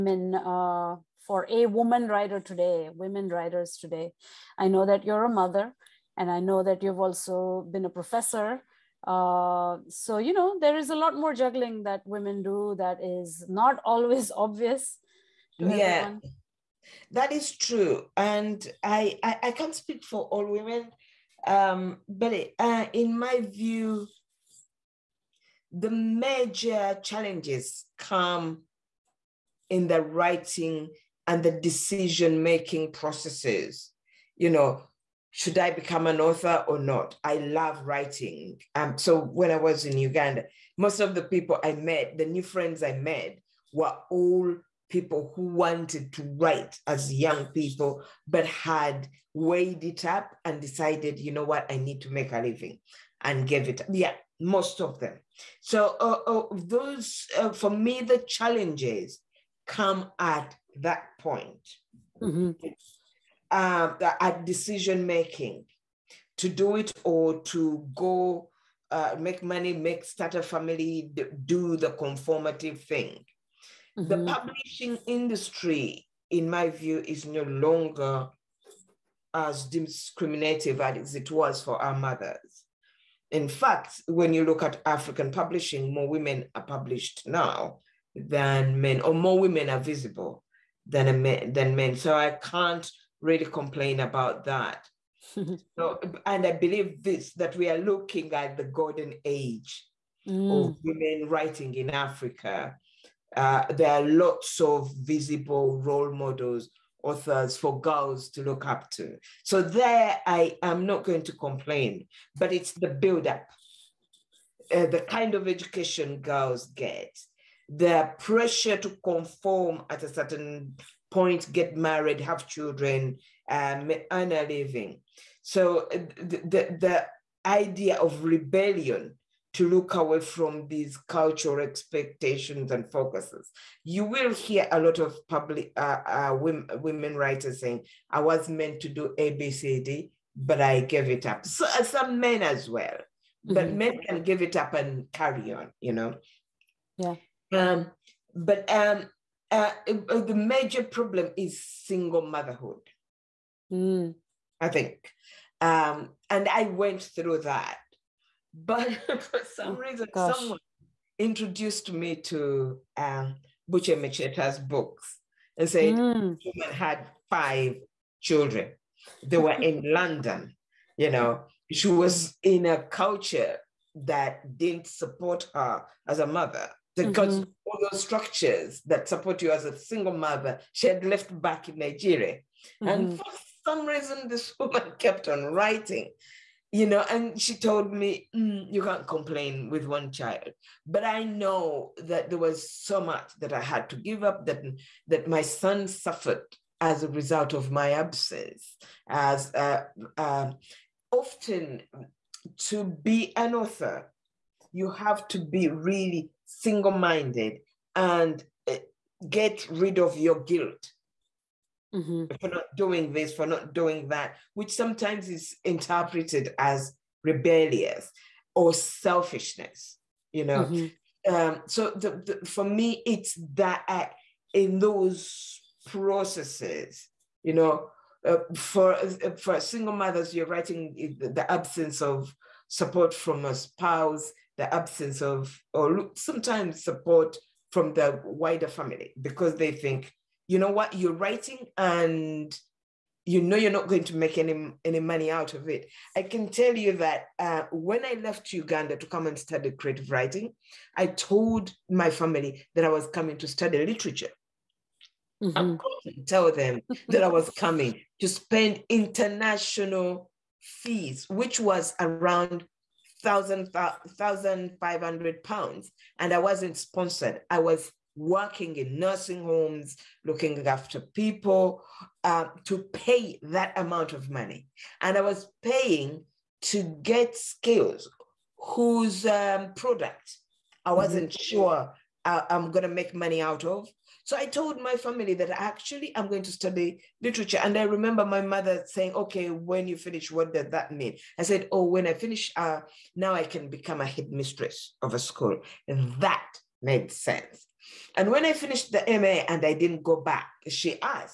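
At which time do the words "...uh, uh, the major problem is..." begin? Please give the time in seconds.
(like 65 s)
149 s.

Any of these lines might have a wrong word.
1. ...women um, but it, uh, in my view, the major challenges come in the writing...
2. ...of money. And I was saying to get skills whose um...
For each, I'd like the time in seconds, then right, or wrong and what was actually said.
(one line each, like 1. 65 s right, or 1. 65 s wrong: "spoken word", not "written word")
1. 20 s right
2. 274 s wrong: "paying", not "saying".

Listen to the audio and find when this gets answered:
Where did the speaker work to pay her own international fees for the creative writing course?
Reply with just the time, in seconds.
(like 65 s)
268 s.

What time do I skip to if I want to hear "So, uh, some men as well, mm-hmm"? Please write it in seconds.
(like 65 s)
141 s.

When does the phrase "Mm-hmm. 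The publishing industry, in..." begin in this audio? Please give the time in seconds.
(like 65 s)
73 s.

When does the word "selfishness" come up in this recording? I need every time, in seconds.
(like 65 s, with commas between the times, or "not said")
218 s.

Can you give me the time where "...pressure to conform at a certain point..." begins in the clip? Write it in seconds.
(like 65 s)
118 s.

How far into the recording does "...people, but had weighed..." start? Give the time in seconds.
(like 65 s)
47 s.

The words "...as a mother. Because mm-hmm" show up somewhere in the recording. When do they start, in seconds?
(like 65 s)
176 s.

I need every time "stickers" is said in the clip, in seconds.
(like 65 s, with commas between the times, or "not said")
not said.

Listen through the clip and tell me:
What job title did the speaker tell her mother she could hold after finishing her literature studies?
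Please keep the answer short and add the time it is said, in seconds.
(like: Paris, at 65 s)
Headmistress, at 294 s.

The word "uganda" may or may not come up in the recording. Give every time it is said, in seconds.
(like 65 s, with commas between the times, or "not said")
39 s, 248 s.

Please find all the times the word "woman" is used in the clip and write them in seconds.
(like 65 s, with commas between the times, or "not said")
1 s, 166 s, 184 s.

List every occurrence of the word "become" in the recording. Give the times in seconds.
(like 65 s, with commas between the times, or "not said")
35 s, 293 s.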